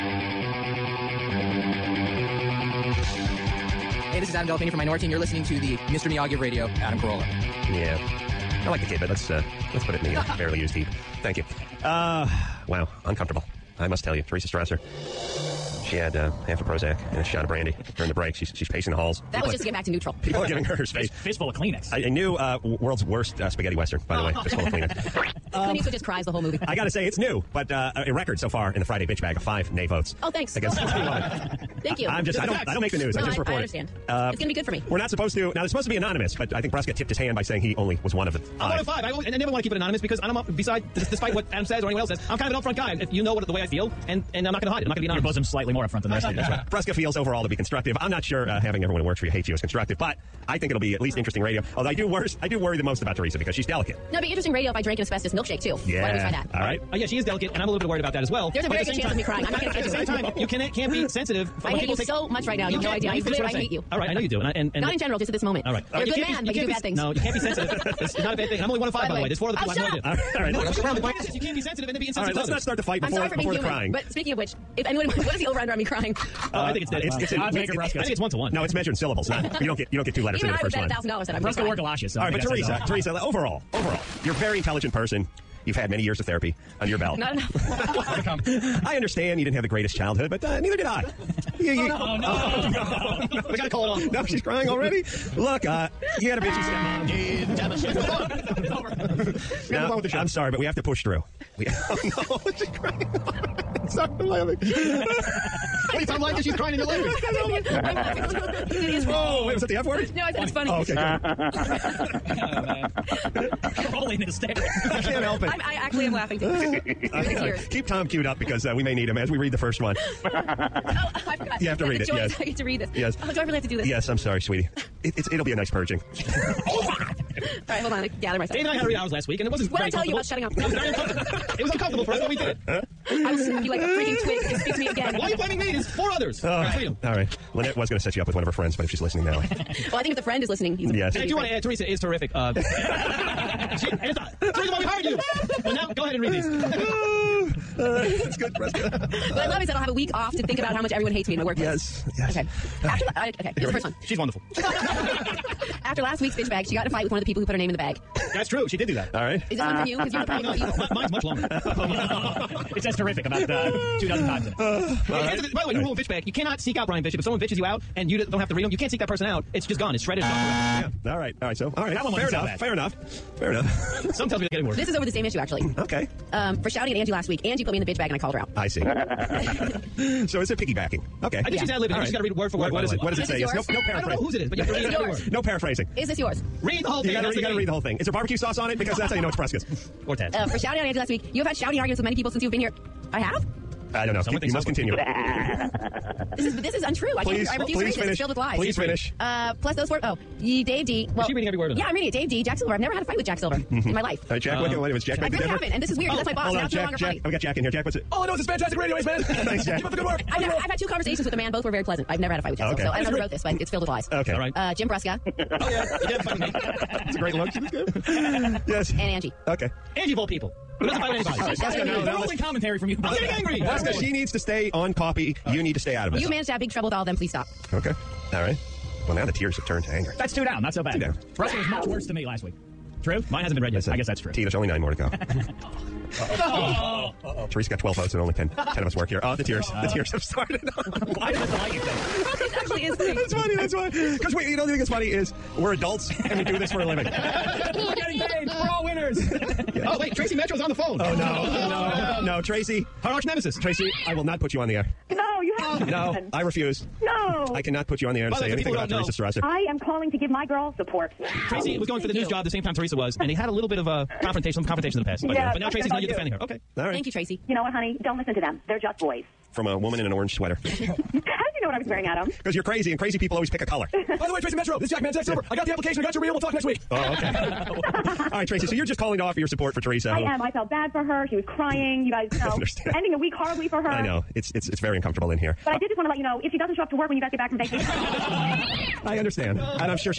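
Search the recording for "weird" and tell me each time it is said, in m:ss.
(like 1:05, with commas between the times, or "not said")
3:25.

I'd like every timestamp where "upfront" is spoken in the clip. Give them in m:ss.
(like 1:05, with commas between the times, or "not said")
0:42.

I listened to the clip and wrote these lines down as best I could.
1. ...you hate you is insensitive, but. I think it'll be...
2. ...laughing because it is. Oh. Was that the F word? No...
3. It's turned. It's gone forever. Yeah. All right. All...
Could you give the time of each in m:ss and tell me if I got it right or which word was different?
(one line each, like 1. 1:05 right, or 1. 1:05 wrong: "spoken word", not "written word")
1. 0:49 wrong: "constructive", not "insensitive"
2. 1:47 right
3. 2:49 wrong: "shredded", not "turned".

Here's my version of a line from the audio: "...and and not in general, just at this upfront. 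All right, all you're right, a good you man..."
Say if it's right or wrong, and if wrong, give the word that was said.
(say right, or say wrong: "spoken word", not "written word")
wrong: "moment", not "upfront".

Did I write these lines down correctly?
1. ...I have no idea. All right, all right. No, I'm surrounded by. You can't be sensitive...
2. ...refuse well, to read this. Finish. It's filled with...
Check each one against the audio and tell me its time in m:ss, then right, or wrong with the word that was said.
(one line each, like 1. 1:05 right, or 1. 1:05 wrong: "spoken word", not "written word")
1. 1:09 right
2. 3:17 right.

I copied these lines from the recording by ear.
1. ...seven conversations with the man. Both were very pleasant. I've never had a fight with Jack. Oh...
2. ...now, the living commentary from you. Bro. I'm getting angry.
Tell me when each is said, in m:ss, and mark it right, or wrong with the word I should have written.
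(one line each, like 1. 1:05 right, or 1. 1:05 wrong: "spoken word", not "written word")
1. 3:30 wrong: "two", not "seven"
2. 3:41 wrong: "rolling", not "living".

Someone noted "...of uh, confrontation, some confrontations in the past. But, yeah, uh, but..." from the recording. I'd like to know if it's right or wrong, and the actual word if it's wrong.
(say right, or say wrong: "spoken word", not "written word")
right.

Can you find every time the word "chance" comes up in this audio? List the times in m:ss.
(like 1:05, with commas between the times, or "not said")
0:58.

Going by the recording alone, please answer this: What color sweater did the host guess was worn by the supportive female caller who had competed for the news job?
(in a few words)
Orange.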